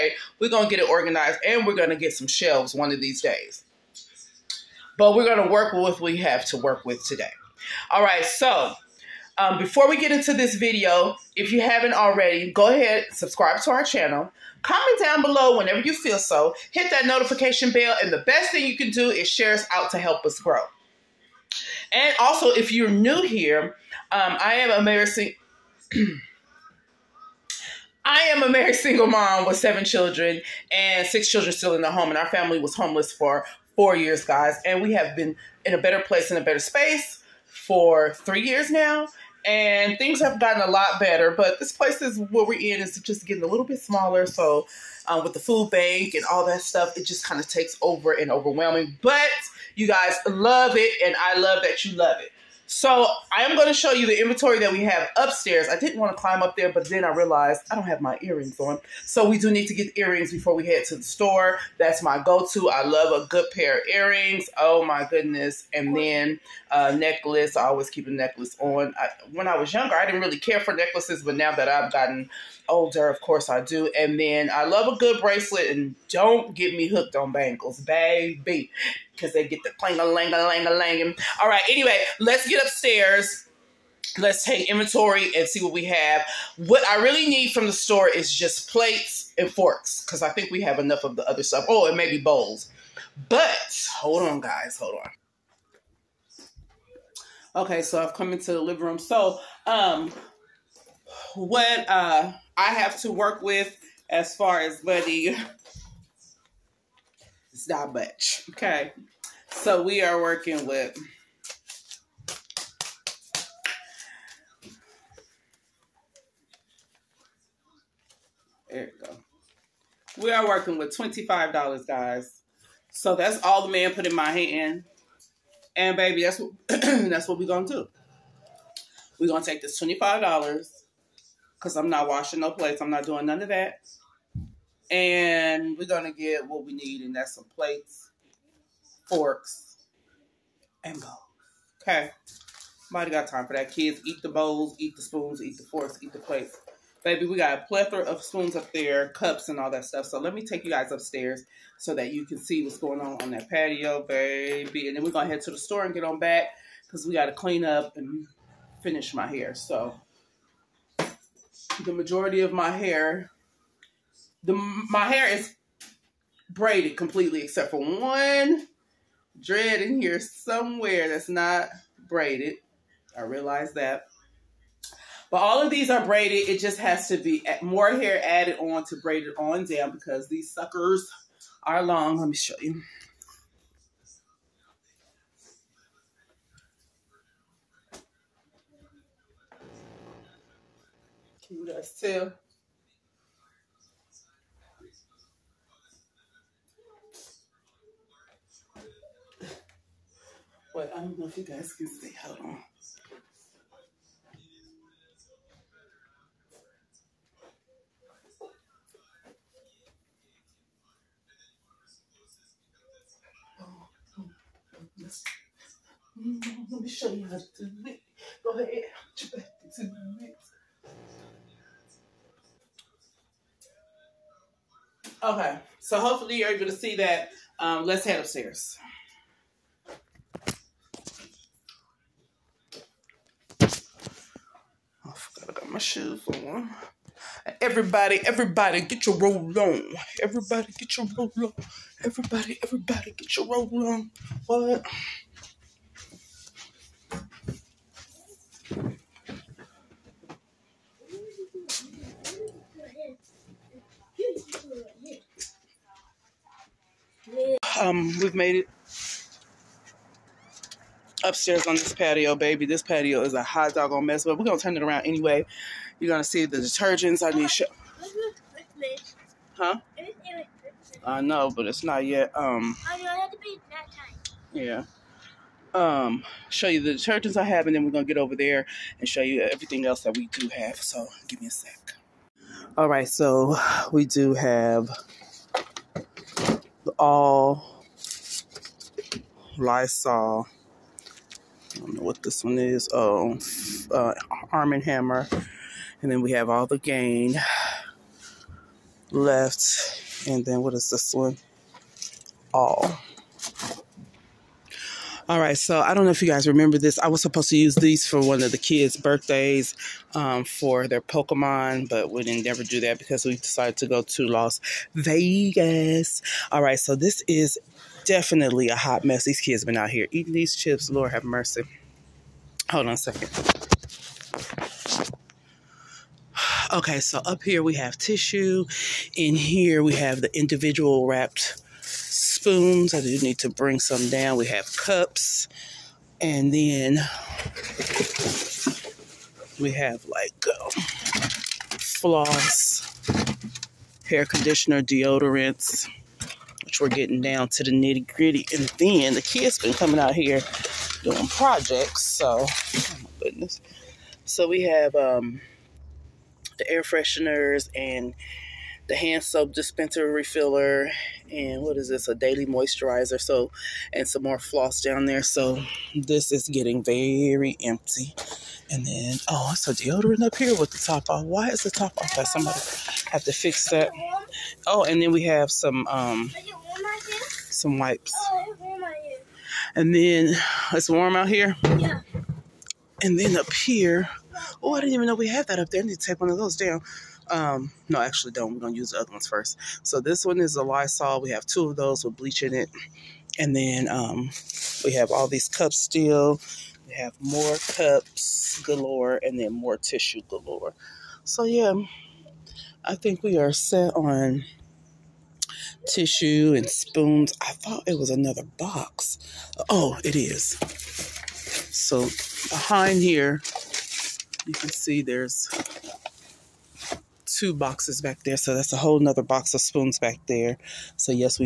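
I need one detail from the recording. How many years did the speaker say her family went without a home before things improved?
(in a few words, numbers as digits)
4 years.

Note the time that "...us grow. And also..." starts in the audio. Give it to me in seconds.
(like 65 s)
20 s.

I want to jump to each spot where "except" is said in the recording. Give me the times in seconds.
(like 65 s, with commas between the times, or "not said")
167 s.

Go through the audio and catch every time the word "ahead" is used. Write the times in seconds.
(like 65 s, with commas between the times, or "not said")
12 s, 218 s.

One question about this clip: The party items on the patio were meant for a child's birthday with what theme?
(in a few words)
Pokemon.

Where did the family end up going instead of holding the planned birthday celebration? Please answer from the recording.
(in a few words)
Las Vegas.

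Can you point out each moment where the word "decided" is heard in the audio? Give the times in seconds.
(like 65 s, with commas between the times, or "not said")
313 s.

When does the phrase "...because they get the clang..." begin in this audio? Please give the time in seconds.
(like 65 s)
79 s.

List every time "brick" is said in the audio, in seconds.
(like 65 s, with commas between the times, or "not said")
not said.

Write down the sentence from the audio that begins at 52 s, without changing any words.
So I am going to show you the inventory that we have upstairs.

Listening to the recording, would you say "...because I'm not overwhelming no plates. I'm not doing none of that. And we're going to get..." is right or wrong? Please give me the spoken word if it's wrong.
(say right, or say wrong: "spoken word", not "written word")
wrong: "washing", not "overwhelming".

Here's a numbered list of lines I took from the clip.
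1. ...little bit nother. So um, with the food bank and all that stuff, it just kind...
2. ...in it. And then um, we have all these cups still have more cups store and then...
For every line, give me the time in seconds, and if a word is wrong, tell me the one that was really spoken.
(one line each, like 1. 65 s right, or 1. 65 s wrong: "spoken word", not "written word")
1. 43 s wrong: "smaller", not "nother"
2. 392 s wrong: "galore", not "store".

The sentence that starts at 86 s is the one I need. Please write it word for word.
What I really need from the store is just plates and forks because I think we have enough of the other stuff.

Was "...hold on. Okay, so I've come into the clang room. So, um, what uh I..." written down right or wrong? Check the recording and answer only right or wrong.
wrong.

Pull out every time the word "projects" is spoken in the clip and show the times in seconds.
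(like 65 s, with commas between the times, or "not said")
351 s.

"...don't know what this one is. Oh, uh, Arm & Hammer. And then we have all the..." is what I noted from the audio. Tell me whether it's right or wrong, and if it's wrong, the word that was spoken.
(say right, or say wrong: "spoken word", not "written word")
right.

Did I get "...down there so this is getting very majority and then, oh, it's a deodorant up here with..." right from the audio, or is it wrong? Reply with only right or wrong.
wrong.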